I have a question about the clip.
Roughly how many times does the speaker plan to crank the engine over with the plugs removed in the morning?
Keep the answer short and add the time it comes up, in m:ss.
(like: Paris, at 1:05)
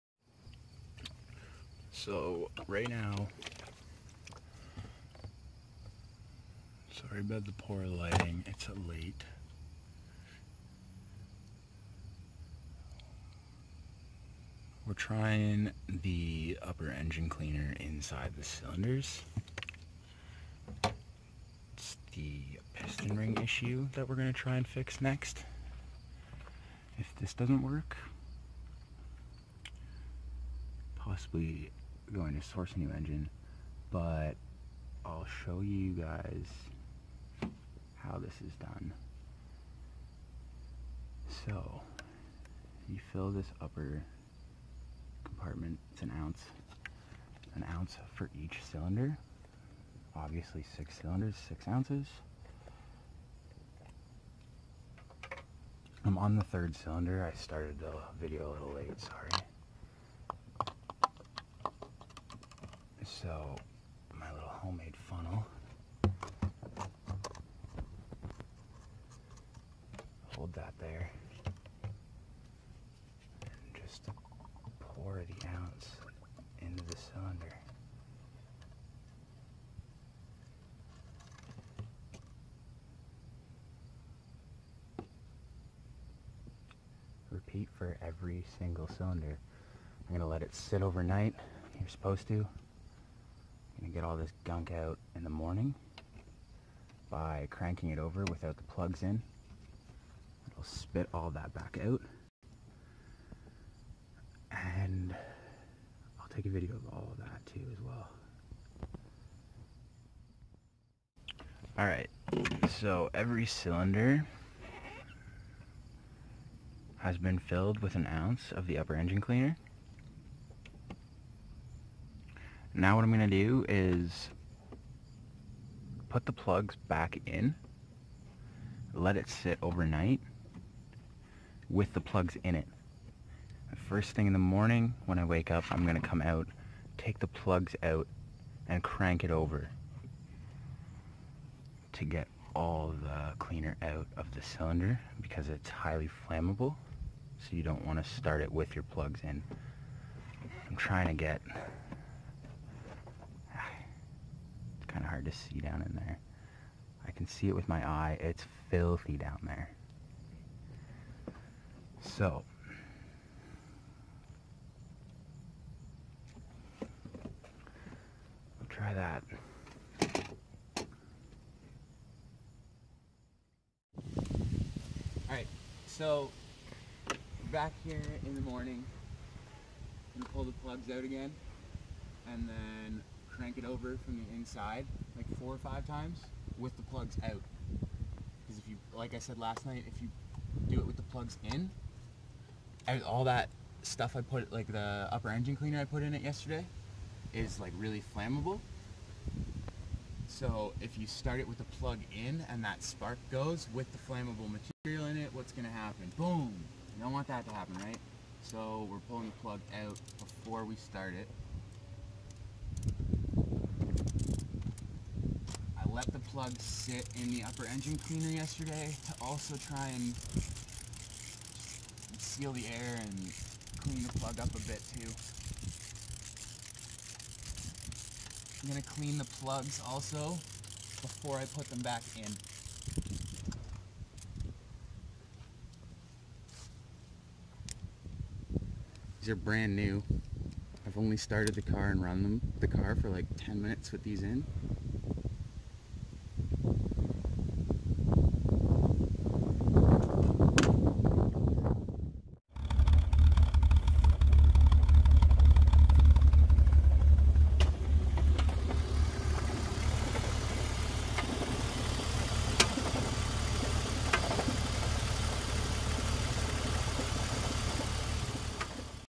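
4 or 5, at 3:05.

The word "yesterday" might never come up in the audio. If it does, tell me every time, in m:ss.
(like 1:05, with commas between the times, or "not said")
3:16, 3:38.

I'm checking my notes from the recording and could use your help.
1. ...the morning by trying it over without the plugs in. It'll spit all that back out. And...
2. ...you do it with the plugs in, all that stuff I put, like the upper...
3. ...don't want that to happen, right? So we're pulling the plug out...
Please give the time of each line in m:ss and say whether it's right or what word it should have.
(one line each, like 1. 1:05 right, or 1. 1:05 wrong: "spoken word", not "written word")
1. 1:35 wrong: "cranking", not "trying"
2. 3:09 right
3. 3:27 right.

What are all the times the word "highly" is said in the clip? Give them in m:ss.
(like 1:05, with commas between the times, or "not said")
2:25.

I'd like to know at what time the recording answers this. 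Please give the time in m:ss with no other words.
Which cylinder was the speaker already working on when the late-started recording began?
0:56.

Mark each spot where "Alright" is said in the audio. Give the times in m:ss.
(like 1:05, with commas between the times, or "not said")
1:51, 2:55.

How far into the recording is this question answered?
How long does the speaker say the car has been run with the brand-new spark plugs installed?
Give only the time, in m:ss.
4:03.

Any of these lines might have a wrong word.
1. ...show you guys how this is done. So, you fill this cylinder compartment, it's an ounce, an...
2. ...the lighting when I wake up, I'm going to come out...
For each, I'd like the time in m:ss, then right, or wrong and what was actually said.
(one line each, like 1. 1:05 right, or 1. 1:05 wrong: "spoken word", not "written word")
1. 0:35 wrong: "upper", not "cylinder"
2. 2:14 wrong: "morning", not "lighting".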